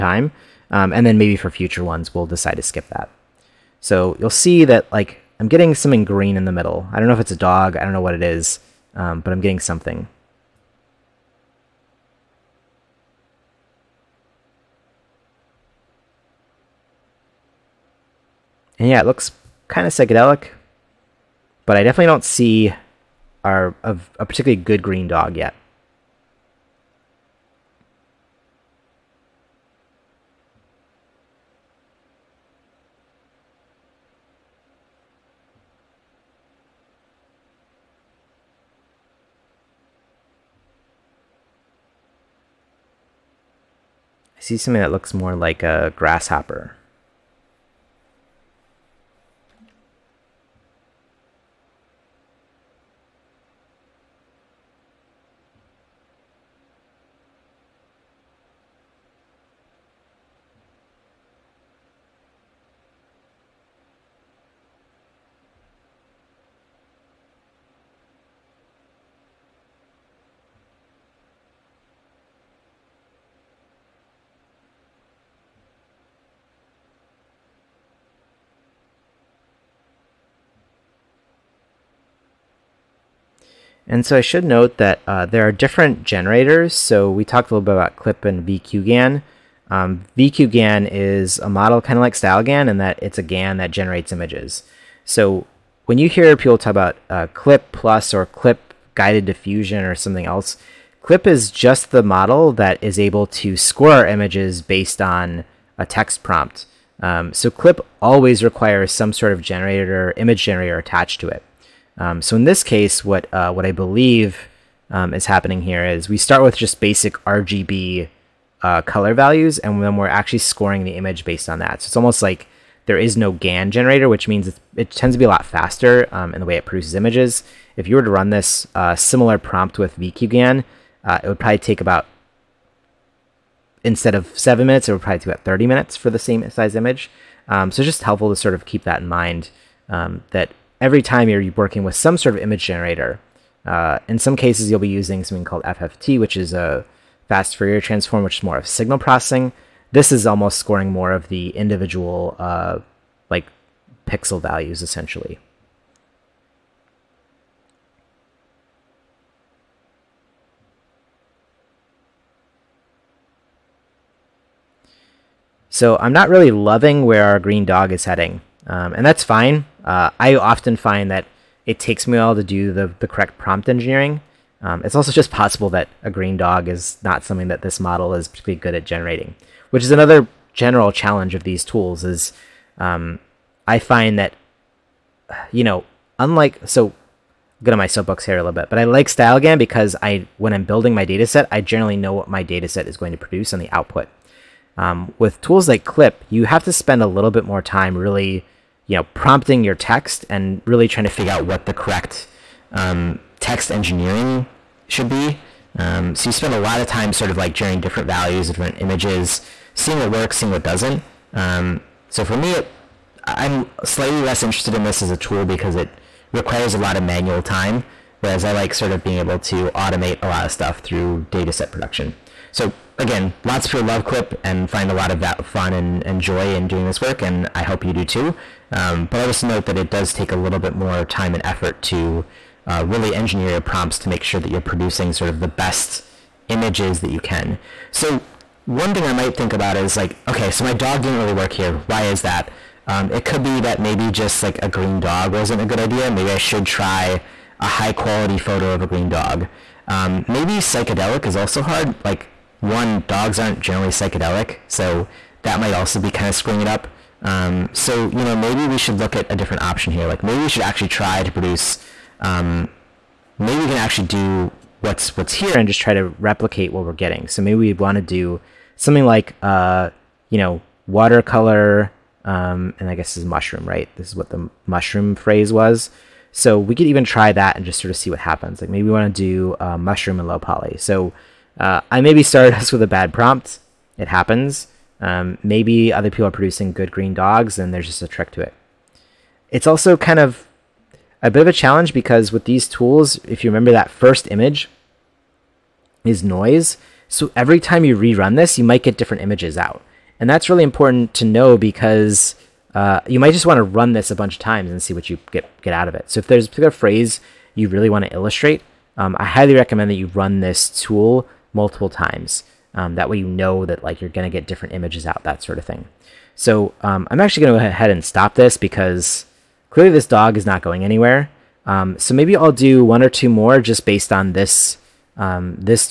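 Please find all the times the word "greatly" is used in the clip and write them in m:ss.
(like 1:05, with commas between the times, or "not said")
not said.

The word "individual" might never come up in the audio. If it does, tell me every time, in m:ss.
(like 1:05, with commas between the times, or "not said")
2:31.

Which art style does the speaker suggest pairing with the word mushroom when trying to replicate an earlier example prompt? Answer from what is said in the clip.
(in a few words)
low poly.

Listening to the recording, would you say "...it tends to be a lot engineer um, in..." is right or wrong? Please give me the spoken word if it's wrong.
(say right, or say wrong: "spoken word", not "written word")
wrong: "faster", not "engineer".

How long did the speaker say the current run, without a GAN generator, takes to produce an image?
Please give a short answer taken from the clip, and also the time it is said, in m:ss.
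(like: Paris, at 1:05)
7 minutes, at 2:14.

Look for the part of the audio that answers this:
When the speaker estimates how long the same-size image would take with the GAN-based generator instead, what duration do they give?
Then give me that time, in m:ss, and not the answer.
2:15.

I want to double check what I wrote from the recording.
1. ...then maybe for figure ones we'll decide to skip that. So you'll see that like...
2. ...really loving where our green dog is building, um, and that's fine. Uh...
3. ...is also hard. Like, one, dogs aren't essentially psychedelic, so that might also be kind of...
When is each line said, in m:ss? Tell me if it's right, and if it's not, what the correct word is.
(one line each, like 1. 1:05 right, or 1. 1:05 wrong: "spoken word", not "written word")
1. 0:01 wrong: "future", not "figure"
2. 2:46 wrong: "heading", not "building"
3. 4:11 wrong: "generally", not "essentially".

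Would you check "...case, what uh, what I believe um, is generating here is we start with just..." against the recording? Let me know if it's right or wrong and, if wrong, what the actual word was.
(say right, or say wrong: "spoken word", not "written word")
wrong: "happening", not "generating".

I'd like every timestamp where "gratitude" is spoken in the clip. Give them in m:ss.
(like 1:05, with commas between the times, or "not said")
not said.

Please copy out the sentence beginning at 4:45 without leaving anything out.
Um, maybe other people are producing good green dogs and there's just a trick to it.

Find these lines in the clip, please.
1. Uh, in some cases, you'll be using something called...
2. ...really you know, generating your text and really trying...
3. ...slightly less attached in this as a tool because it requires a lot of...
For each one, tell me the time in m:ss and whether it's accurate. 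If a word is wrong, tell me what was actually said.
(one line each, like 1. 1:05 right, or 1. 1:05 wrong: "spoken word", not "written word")
1. 2:23 right
2. 3:17 wrong: "prompting", not "generating"
3. 3:33 wrong: "interested", not "attached".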